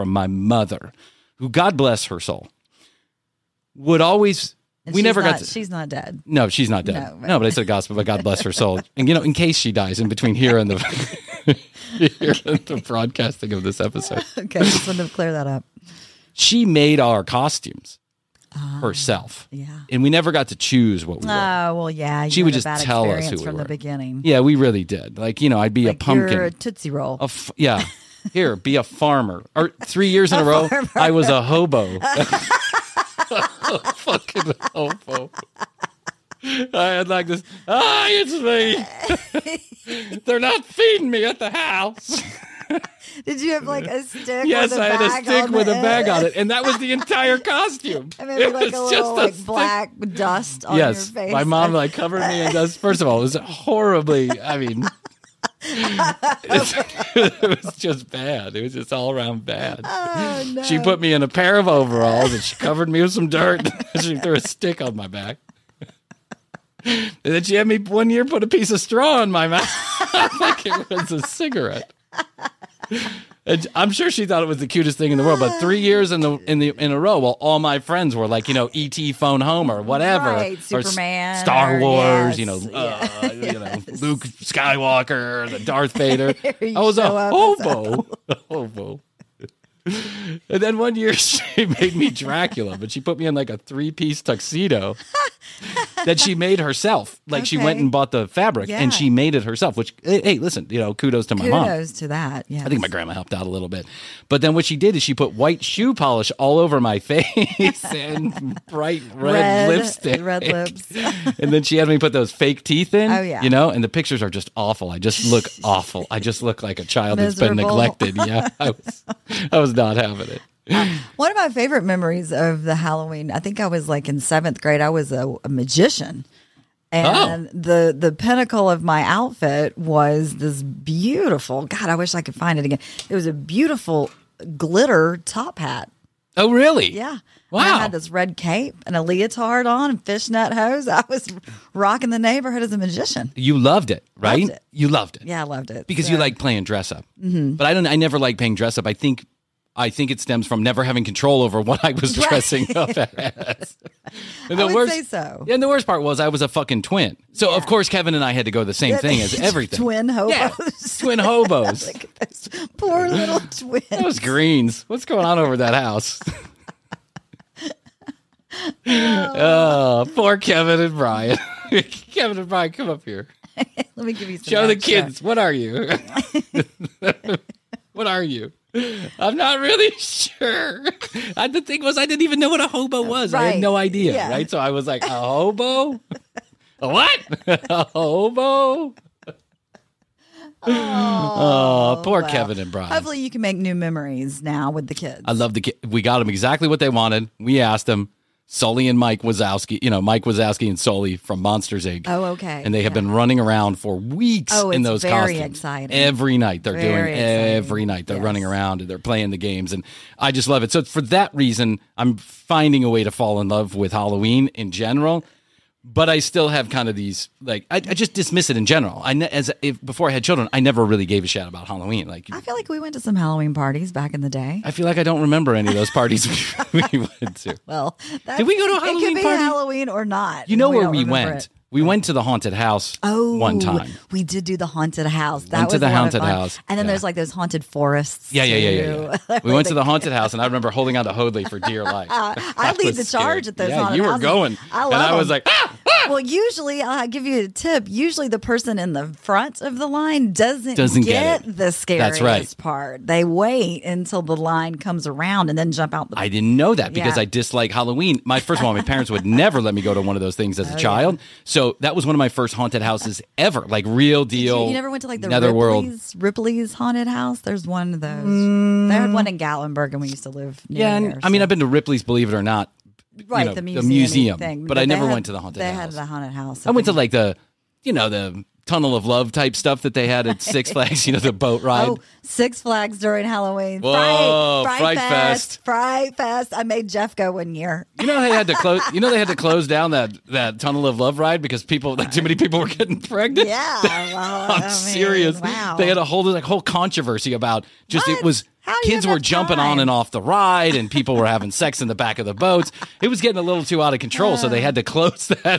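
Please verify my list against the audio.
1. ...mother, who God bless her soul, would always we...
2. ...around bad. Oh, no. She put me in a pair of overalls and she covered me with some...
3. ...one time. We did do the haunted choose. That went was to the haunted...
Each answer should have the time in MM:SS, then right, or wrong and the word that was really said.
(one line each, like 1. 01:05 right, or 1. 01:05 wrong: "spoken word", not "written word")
1. 00:00 right
2. 00:59 right
3. 03:53 wrong: "house", not "choose".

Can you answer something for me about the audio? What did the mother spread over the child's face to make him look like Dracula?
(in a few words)
White shoe polish.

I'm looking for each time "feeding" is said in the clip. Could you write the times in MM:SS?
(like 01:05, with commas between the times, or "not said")
00:40.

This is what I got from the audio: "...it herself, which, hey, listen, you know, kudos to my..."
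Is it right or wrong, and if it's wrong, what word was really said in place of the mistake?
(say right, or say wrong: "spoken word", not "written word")
right.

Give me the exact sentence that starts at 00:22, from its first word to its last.
She would just tell us who we from the beginning.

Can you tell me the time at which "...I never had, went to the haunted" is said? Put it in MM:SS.
04:34.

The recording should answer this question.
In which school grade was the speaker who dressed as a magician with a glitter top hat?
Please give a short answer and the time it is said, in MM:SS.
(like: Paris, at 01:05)
Seventh grade, at 02:04.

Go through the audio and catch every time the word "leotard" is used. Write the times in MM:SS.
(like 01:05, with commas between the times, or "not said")
02:19.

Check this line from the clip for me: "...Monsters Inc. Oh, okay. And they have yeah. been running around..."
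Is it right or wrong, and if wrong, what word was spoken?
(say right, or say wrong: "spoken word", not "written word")
right.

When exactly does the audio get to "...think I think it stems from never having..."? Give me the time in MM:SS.
02:28.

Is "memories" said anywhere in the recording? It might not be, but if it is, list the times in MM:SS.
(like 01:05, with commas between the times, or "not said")
02:01, 03:13.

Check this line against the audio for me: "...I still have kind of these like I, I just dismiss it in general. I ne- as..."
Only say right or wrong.
right.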